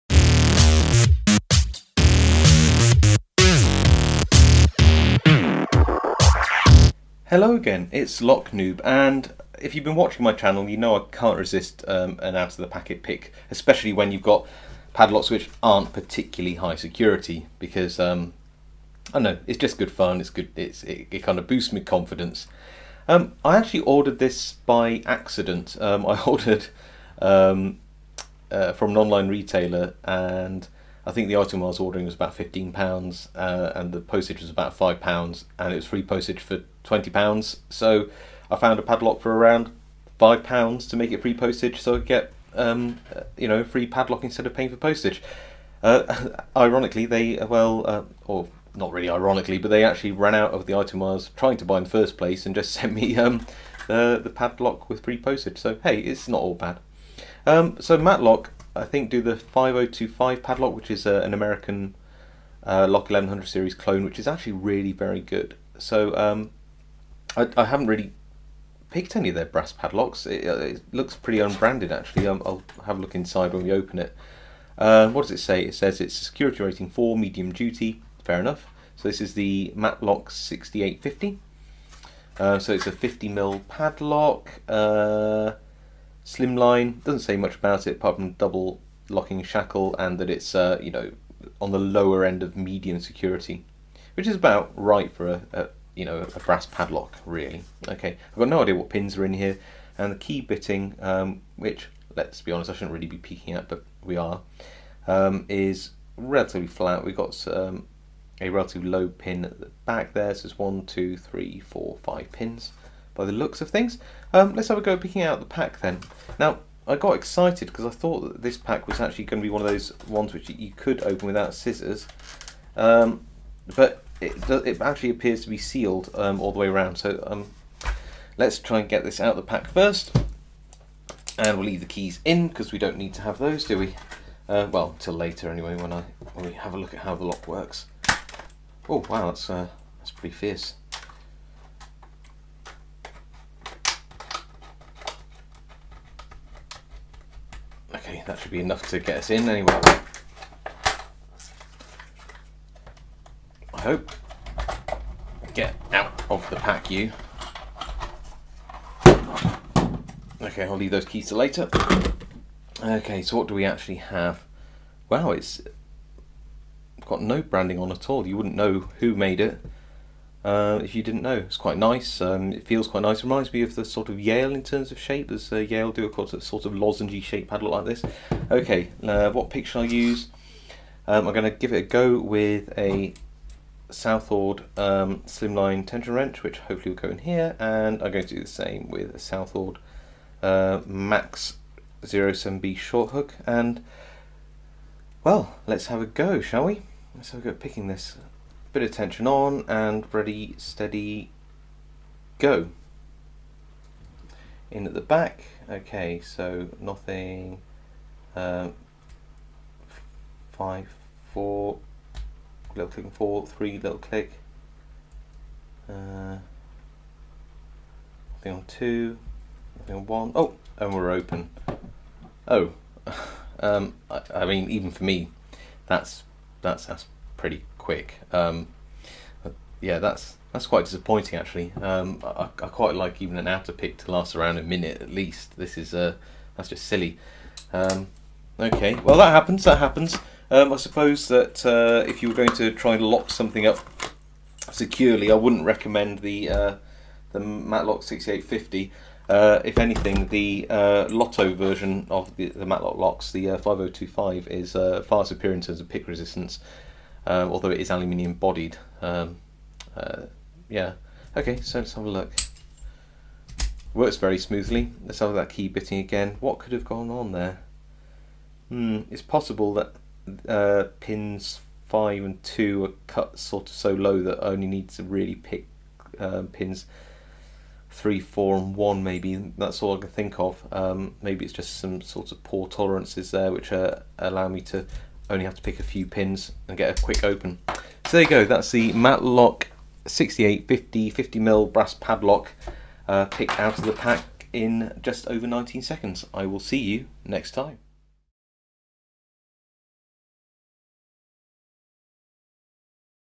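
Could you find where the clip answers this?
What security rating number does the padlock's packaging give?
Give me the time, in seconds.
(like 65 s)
76 s.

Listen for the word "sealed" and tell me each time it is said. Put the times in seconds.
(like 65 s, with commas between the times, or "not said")
125 s.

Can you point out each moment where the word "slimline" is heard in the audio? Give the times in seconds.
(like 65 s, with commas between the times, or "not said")
86 s, 185 s.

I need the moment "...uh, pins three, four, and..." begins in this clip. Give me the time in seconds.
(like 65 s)
276 s.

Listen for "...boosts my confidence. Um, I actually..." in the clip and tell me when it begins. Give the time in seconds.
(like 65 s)
21 s.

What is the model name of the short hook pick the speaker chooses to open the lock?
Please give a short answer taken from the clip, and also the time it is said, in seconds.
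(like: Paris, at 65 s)
Max 07B, at 190 s.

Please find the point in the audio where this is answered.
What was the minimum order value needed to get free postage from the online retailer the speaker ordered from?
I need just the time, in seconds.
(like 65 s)
36 s.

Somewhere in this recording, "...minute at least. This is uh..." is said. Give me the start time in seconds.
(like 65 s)
234 s.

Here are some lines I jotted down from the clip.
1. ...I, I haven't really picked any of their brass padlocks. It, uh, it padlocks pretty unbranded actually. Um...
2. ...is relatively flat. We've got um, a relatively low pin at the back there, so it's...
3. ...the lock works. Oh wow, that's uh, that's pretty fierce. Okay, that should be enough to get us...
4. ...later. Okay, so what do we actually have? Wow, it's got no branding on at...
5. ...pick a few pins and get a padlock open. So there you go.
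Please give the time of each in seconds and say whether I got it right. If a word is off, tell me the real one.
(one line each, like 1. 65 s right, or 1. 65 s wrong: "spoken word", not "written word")
1. 67 s wrong: "looks", not "padlocks"
2. 105 s right
3. 137 s right
4. 161 s right
5. 285 s wrong: "quick", not "padlock".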